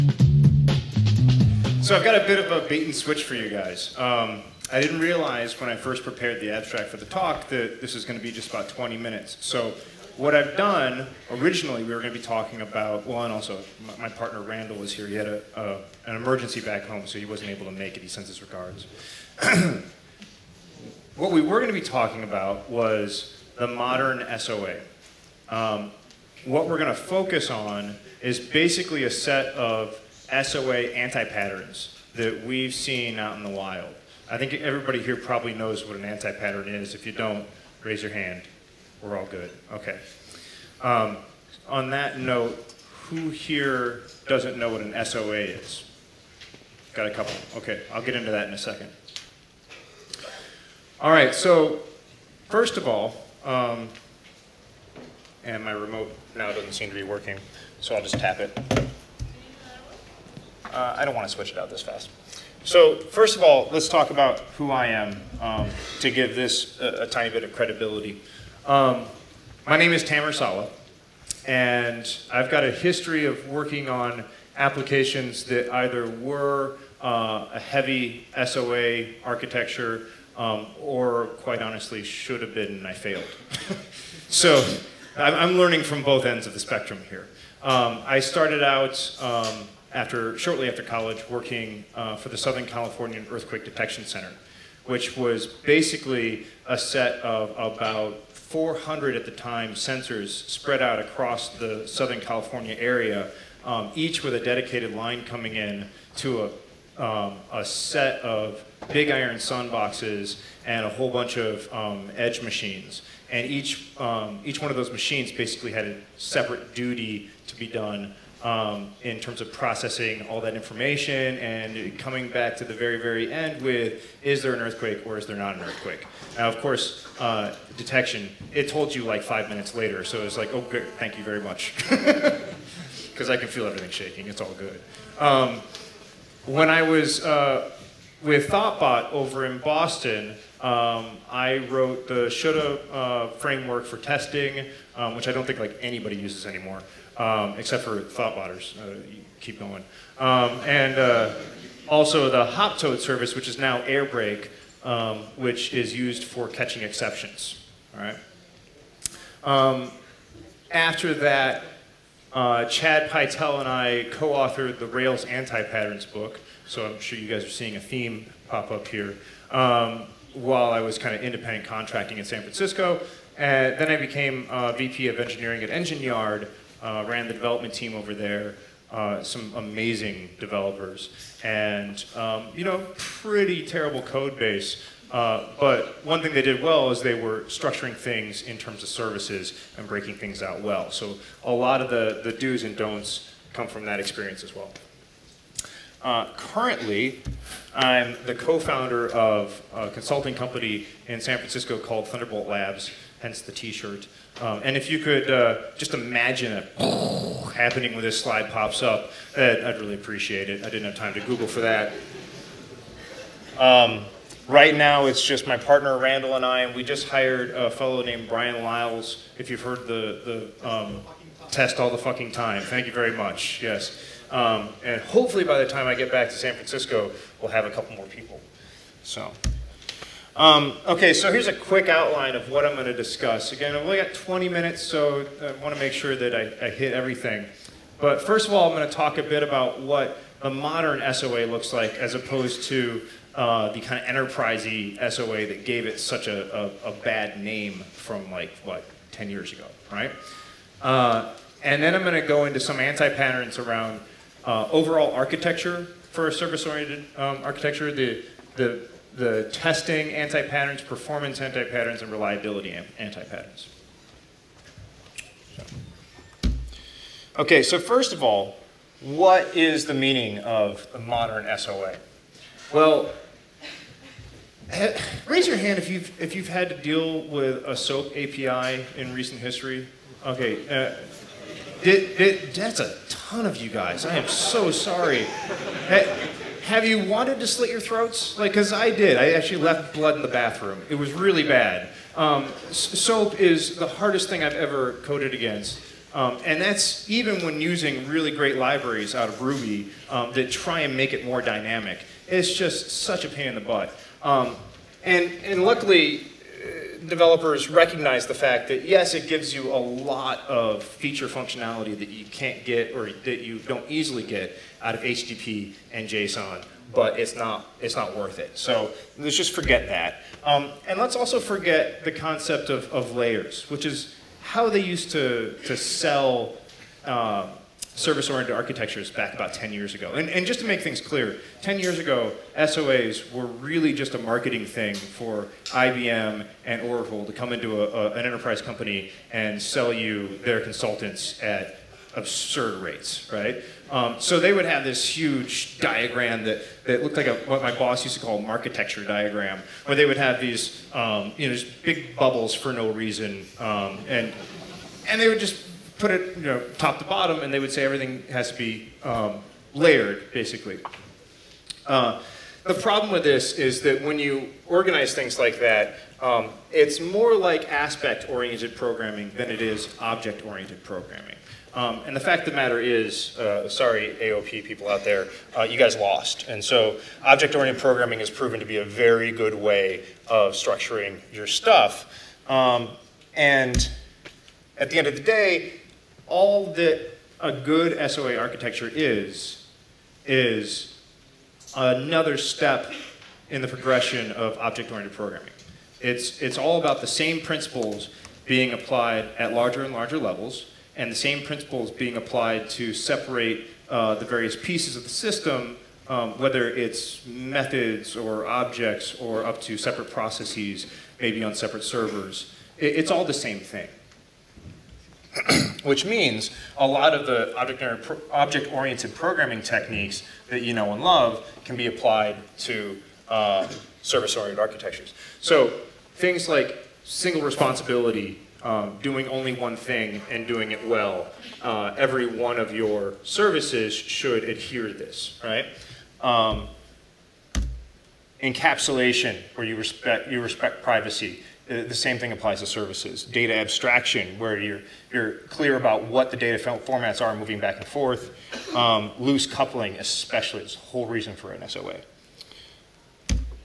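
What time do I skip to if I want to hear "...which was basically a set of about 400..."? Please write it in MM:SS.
01:34.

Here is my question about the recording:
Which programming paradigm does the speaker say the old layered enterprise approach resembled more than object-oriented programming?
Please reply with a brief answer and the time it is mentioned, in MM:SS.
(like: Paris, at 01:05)
Aspect-oriented programming, at 06:07.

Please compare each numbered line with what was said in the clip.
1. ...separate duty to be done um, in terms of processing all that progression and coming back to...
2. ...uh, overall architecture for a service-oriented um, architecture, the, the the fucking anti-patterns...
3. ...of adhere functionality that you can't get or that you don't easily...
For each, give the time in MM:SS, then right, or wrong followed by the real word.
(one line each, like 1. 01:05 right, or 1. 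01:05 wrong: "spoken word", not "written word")
1. 01:56 wrong: "information", not "progression"
2. 04:14 wrong: "testing", not "fucking"
3. 05:10 wrong: "feature", not "adhere".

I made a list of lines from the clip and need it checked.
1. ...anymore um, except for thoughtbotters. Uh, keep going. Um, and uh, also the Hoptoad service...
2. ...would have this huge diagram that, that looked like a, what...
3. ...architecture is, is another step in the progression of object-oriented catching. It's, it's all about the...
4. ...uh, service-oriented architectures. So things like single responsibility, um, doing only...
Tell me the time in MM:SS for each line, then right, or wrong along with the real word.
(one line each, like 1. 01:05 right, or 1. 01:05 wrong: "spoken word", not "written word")
1. 02:26 right
2. 05:44 right
3. 06:28 wrong: "programming", not "catching"
4. 07:03 right.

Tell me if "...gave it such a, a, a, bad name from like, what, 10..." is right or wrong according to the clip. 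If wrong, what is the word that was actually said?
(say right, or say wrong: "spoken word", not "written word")
right.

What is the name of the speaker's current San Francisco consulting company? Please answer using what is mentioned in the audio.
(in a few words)
Thunderbolt Labs.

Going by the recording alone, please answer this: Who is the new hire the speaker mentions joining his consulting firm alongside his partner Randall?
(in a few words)
Bryan Liles.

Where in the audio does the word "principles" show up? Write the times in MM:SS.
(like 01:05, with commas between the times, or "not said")
06:37, 06:41.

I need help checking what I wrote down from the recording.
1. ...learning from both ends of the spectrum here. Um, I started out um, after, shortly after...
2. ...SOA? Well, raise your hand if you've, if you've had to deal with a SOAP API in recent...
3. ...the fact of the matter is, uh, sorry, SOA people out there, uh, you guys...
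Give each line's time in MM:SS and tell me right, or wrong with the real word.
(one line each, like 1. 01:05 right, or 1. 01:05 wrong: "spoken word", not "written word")
1. 01:25 right
2. 04:31 right
3. 06:12 wrong: "AOP", not "SOA".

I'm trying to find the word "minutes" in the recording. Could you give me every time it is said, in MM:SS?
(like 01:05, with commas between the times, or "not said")
00:08, 02:09, 03:54.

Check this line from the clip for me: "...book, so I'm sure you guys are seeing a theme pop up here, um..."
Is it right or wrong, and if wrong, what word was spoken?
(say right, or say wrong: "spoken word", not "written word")
right.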